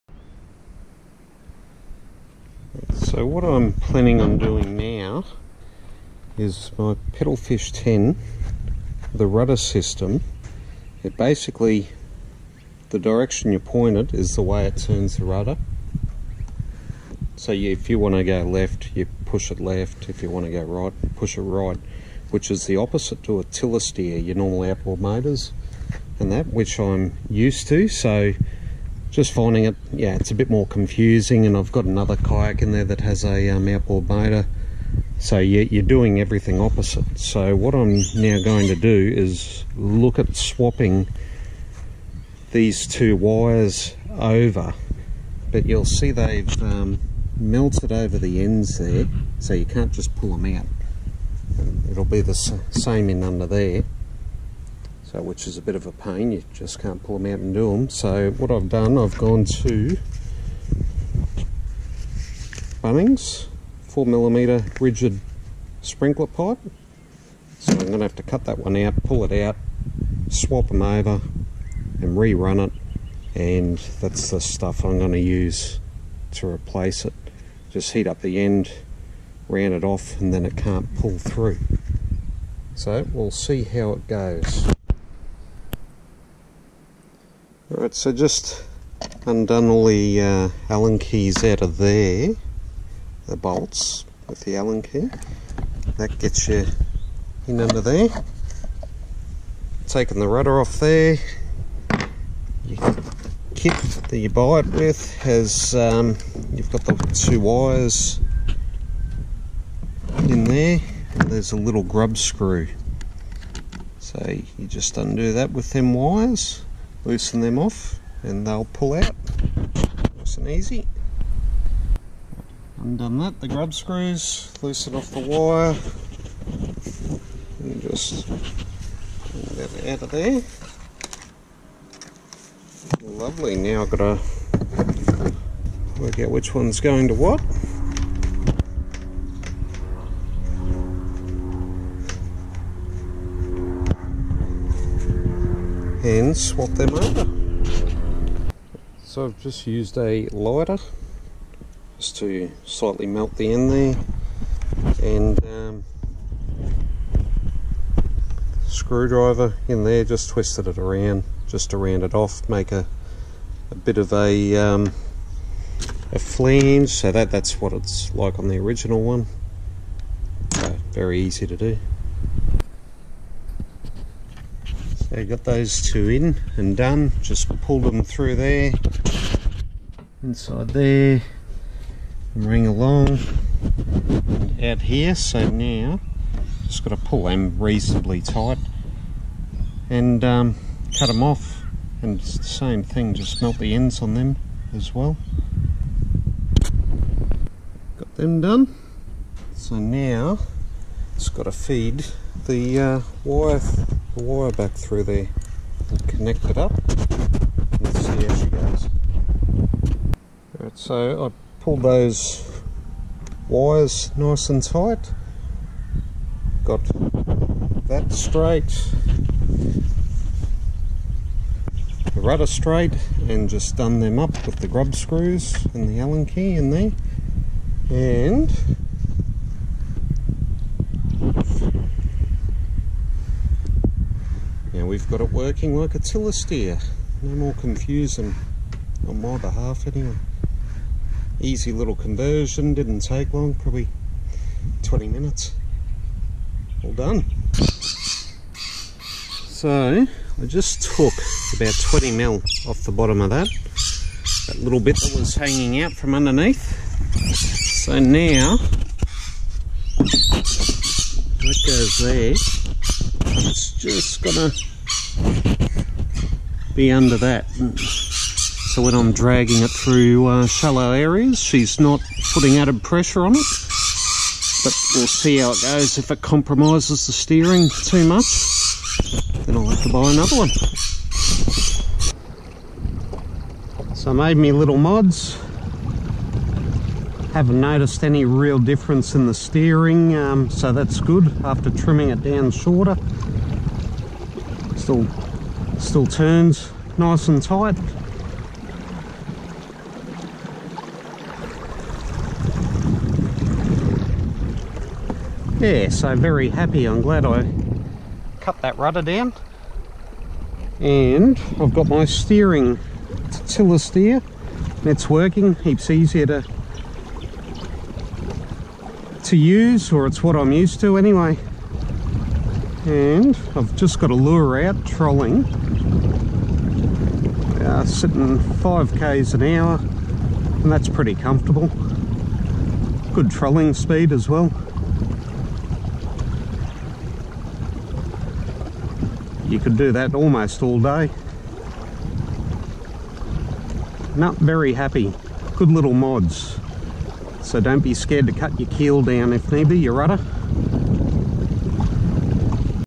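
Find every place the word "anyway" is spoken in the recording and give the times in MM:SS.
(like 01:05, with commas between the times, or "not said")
03:59, 05:20.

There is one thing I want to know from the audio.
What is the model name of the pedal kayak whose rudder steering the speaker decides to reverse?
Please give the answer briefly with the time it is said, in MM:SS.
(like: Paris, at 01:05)
Pedalfish 10, at 00:07.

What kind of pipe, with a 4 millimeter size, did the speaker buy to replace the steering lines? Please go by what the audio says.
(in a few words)
rigid sprinkler pipe.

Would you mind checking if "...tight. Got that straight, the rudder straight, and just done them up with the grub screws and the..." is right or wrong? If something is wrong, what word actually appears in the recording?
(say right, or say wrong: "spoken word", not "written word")
right.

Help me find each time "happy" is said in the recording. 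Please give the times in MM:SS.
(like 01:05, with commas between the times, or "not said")
05:06, 05:44.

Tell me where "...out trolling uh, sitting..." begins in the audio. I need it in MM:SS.
05:24.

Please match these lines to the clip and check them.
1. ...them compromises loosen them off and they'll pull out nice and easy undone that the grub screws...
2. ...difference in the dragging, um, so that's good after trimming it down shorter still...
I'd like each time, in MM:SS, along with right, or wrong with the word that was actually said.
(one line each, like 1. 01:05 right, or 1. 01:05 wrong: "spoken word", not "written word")
1. 01:55 wrong: "wires", not "compromises"
2. 04:48 wrong: "steering", not "dragging".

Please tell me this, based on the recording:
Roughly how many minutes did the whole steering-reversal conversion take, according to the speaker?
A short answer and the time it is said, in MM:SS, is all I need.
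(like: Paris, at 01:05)
20 minutes, at 04:04.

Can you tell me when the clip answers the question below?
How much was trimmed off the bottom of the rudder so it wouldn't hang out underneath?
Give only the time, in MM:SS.
04:11.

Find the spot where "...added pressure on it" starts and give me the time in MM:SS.
04:32.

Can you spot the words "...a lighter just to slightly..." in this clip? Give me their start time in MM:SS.
02:29.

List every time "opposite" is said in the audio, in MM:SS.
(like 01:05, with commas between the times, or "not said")
00:22, 00:36.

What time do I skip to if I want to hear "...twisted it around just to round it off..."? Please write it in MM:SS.
02:40.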